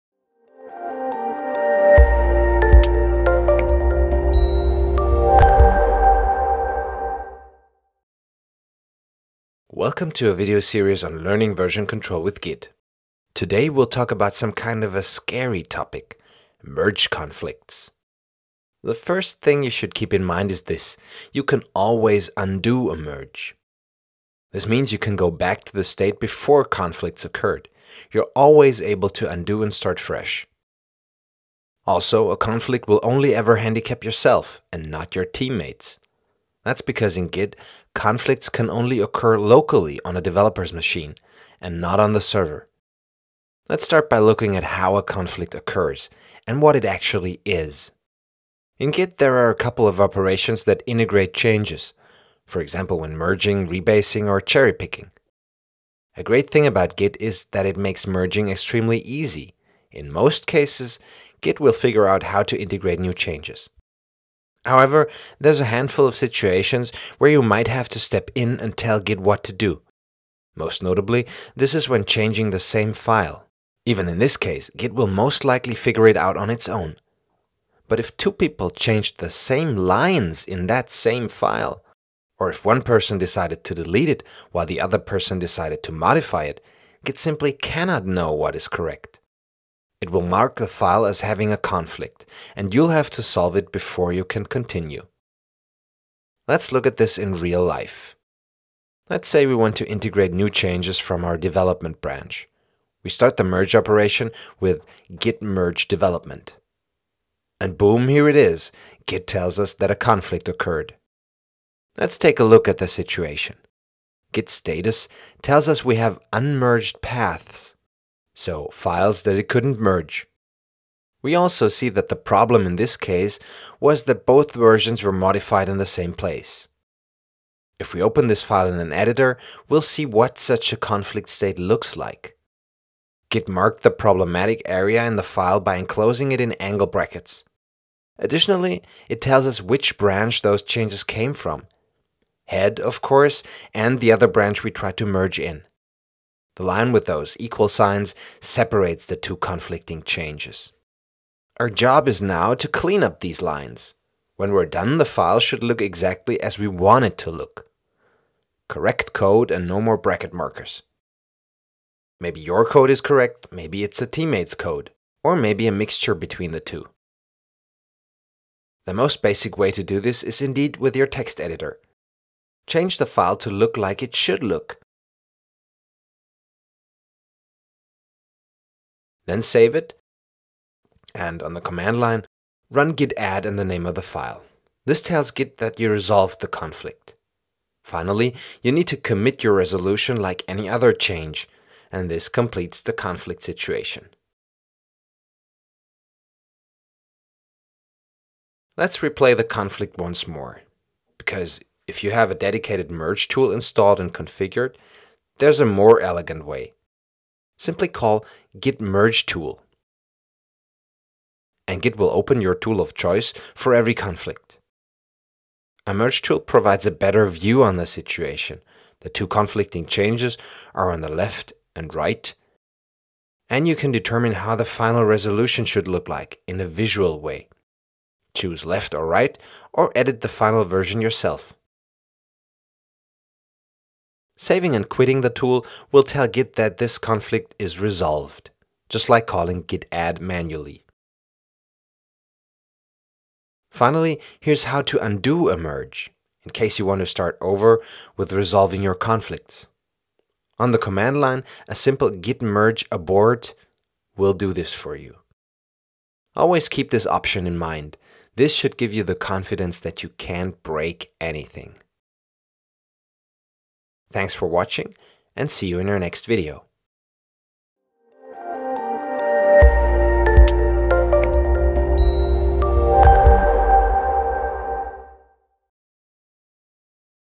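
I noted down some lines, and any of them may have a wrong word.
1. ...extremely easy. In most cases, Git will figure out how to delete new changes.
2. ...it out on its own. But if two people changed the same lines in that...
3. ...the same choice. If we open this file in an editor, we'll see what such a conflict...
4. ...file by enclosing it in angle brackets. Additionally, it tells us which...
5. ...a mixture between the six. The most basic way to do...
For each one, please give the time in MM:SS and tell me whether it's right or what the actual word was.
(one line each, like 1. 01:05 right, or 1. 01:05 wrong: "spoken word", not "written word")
1. 00:58 wrong: "integrate", not "delete"
2. 01:16 right
3. 02:05 wrong: "place", not "choice"
4. 02:15 right
5. 02:45 wrong: "two", not "six".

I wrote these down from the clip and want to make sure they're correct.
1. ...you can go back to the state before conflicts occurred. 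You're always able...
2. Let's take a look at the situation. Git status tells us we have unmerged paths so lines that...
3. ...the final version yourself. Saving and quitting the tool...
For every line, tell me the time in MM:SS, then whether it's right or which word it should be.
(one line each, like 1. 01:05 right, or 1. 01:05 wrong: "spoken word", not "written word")
1. 00:24 right
2. 01:51 wrong: "files", not "lines"
3. 03:50 right.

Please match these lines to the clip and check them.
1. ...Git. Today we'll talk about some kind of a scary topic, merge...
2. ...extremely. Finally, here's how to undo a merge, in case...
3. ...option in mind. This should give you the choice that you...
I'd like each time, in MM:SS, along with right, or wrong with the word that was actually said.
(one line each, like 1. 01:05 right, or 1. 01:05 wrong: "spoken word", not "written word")
1. 00:12 right
2. 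04:00 wrong: "manually", not "extremely"
3. 04:17 wrong: "confidence", not "choice".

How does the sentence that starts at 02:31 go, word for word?
Our job is now to clean up these lines.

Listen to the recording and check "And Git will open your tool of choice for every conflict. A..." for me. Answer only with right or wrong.
right.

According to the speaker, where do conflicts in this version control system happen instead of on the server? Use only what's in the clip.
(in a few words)
A developer's machine.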